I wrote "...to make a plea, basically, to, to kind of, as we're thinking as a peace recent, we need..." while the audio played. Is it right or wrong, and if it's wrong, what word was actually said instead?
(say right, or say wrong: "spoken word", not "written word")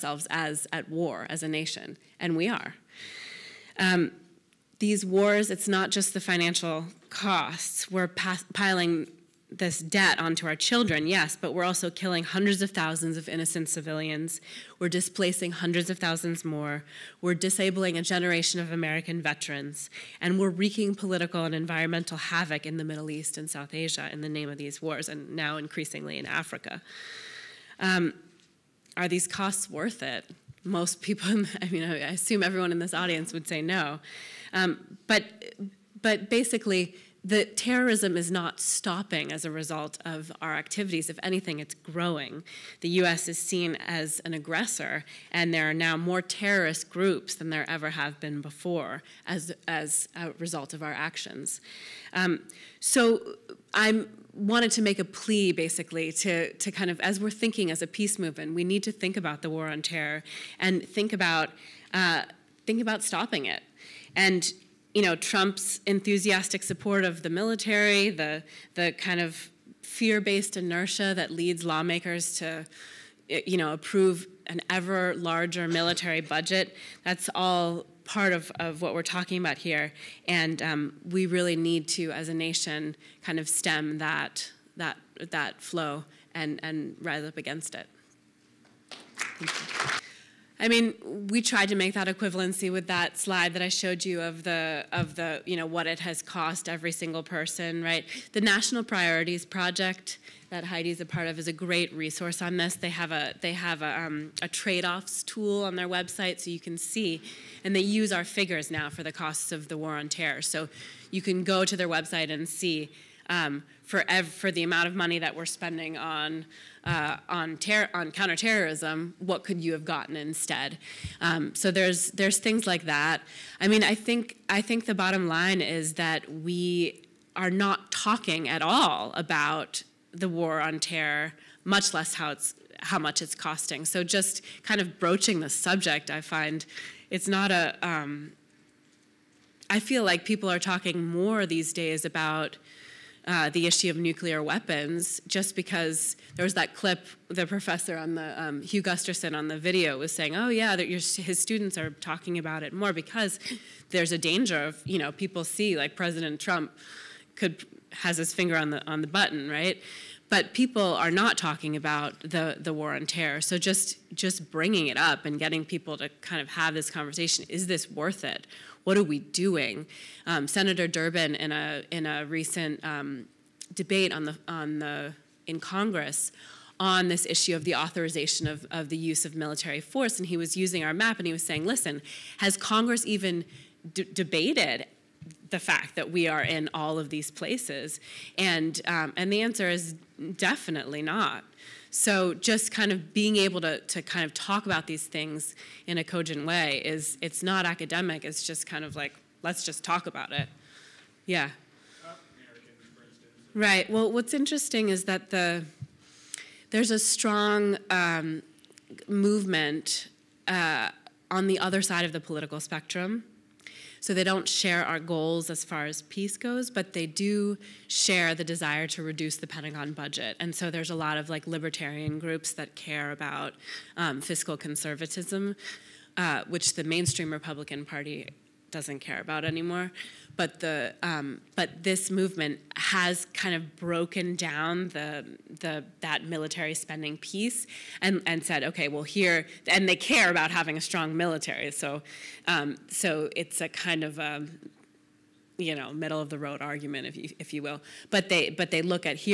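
wrong: "movement", not "recent".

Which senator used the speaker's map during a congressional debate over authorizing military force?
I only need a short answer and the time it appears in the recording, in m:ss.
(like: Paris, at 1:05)
Senator Durbin, at 2:50.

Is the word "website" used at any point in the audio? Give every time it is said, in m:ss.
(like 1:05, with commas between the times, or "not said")
1:45, 1:51.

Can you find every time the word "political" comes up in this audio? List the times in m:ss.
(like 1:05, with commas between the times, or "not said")
0:20, 3:32.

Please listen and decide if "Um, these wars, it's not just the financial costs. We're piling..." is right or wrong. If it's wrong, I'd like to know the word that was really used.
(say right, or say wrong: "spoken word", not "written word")
right.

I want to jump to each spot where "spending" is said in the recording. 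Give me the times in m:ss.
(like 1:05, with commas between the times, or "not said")
1:55, 3:56.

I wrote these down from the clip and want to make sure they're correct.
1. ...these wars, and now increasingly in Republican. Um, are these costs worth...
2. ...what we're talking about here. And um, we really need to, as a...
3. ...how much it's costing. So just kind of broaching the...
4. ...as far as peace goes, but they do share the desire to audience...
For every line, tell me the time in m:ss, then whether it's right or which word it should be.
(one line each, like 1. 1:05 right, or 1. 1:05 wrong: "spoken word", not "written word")
1. 0:24 wrong: "Africa", not "Republican"
2. 1:18 right
3. 2:12 right
4. 3:35 wrong: "reduce", not "audience".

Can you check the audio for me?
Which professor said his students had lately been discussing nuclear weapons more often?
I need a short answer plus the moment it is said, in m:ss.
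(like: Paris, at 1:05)
Hugh Gusterson, at 2:28.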